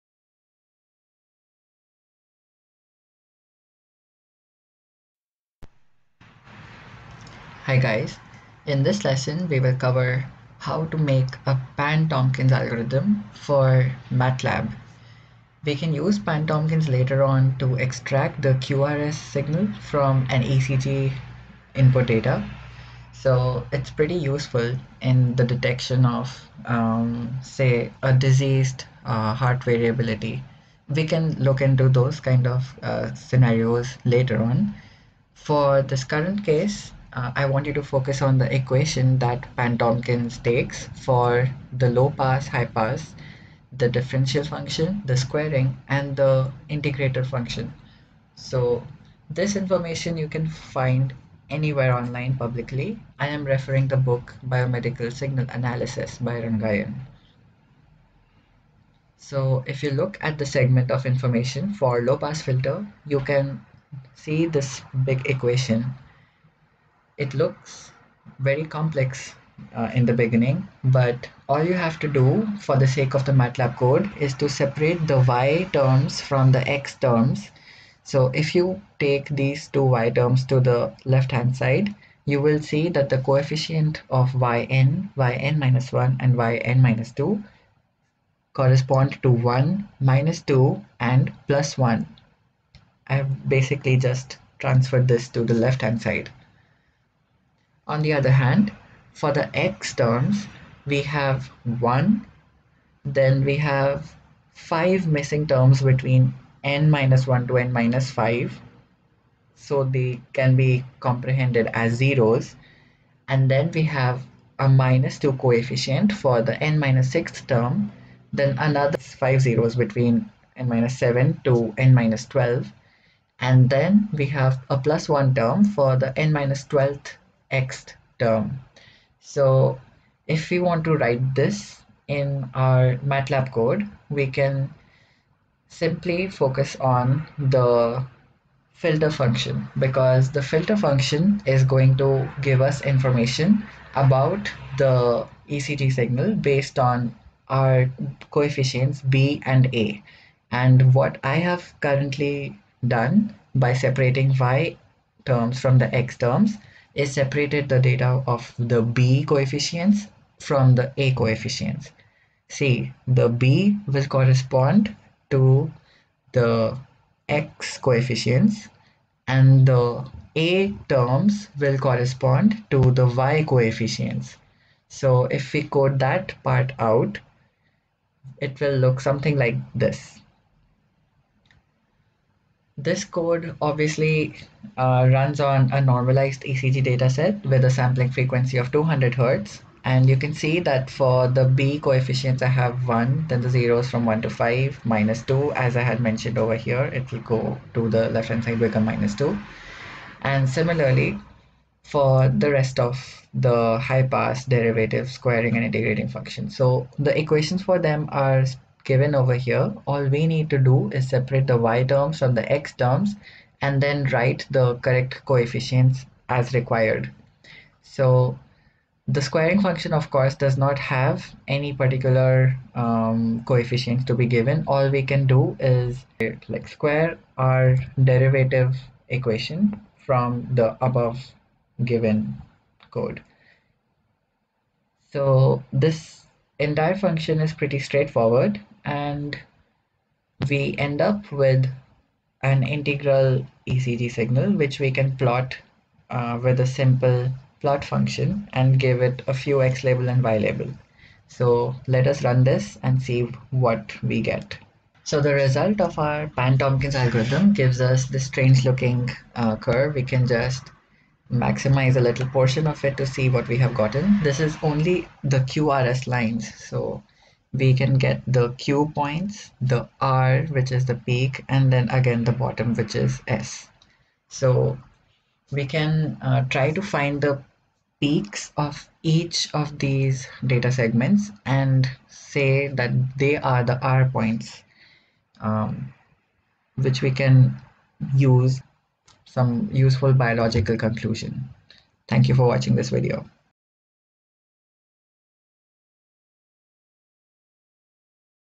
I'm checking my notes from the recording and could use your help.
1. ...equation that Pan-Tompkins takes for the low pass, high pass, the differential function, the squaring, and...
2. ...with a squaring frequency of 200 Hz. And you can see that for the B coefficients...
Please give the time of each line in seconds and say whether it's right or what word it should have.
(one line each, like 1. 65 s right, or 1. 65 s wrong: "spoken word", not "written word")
1. 38 s right
2. 187 s wrong: "sampling", not "squaring".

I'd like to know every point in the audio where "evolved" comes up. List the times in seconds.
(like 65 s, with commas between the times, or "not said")
not said.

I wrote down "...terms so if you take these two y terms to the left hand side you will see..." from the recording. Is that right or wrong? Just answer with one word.
right.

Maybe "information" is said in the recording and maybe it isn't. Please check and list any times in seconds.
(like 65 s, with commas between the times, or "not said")
49 s, 61 s, 142 s.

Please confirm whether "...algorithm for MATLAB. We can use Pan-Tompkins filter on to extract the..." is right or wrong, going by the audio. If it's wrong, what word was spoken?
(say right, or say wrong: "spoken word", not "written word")
wrong: "later", not "filter".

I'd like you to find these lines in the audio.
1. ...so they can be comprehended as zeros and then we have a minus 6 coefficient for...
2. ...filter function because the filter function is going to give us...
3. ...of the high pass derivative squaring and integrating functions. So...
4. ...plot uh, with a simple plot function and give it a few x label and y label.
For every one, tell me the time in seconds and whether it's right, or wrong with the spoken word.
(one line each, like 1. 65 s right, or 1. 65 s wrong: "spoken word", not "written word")
1. 109 s wrong: "2", not "6"
2. 138 s right
3. 202 s right
4. 245 s right.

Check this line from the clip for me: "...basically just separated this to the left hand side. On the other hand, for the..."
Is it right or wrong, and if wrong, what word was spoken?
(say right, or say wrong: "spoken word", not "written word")
wrong: "transferred", not "separated".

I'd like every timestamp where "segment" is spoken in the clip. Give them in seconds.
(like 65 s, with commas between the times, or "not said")
60 s, 280 s.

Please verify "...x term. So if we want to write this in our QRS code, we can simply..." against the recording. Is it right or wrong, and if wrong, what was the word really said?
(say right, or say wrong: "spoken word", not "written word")
wrong: "MATLAB", not "QRS".